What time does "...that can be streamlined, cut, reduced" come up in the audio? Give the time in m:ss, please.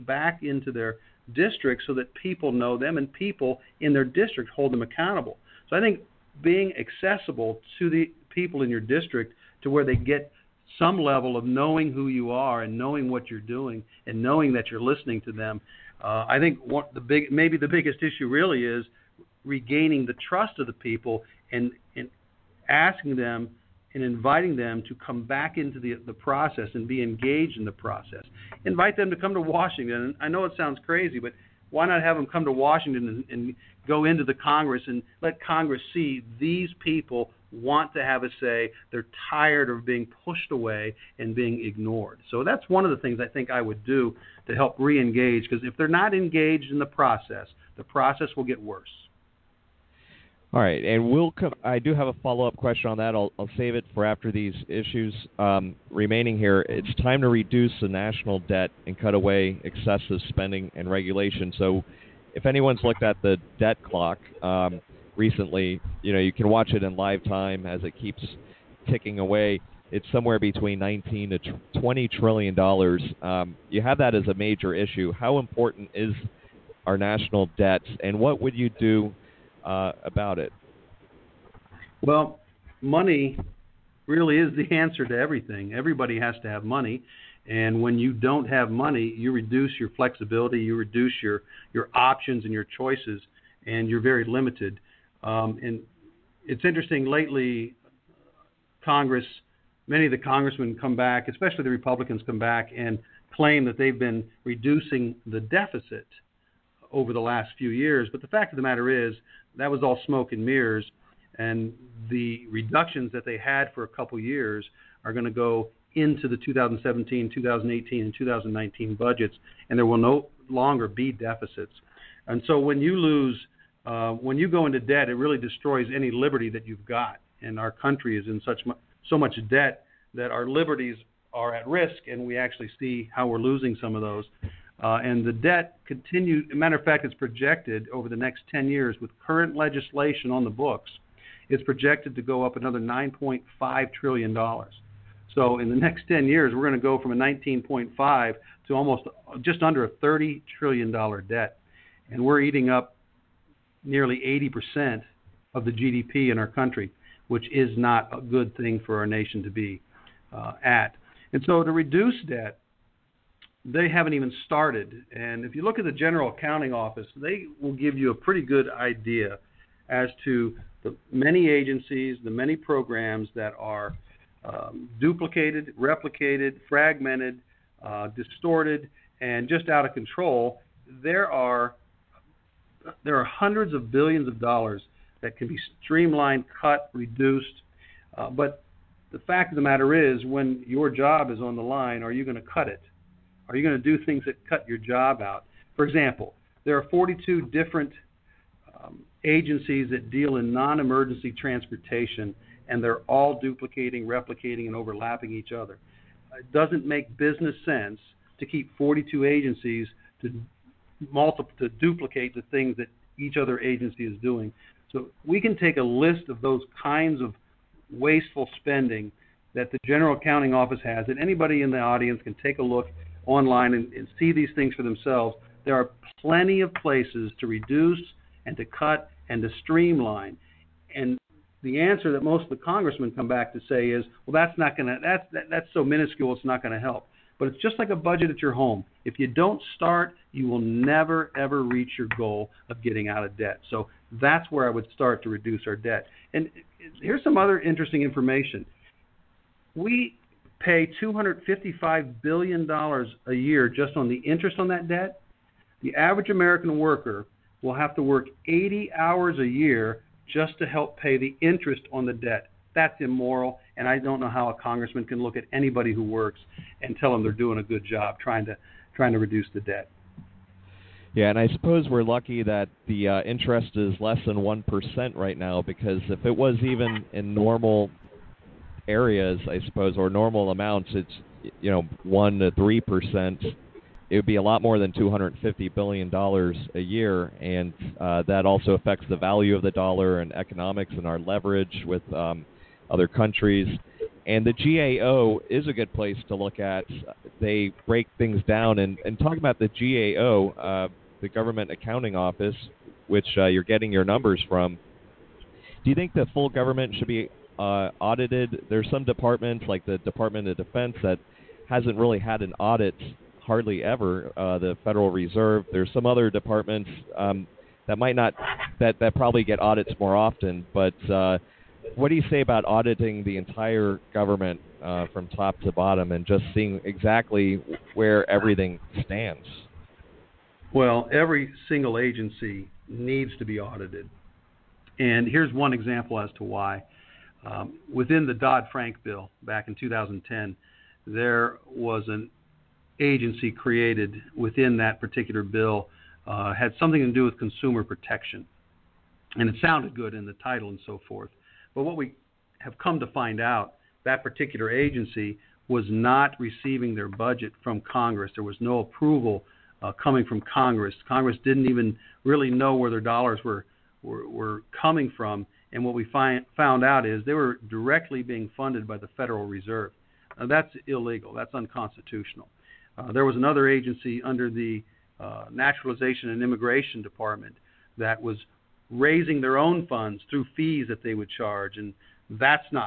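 3:05.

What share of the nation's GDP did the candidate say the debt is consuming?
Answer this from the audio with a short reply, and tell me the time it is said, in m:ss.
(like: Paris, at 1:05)
80 percent, at 2:34.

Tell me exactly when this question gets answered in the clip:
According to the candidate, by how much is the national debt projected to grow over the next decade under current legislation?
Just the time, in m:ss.
2:22.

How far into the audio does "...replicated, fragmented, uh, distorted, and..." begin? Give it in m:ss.
2:55.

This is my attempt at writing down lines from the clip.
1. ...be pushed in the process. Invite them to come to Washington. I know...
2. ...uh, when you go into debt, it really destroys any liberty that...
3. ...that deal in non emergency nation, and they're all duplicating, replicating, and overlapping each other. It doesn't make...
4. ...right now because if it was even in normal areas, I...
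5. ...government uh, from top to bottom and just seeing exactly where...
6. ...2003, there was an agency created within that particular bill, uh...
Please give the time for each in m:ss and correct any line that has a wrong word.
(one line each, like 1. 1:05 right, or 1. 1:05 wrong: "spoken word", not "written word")
1. 0:26 wrong: "engaged", not "pushed"
2. 2:03 right
3. 3:19 wrong: "transportation", not "nation"
4. 4:35 right
5. 5:24 right
6. 5:39 wrong: "2010", not "2003".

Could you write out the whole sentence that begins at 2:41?
And so to reduce debt, they haven't even started.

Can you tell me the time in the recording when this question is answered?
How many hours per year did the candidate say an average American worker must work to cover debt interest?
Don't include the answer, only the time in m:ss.
4:18.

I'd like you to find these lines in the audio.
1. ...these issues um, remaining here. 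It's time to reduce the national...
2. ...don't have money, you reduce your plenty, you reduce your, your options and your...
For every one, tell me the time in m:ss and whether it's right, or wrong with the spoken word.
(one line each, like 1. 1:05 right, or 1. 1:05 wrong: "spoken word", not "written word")
1. 0:54 right
2. 1:28 wrong: "flexibility", not "plenty".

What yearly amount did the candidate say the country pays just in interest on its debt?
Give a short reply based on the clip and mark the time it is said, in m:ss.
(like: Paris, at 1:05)
$255 billion, at 4:11.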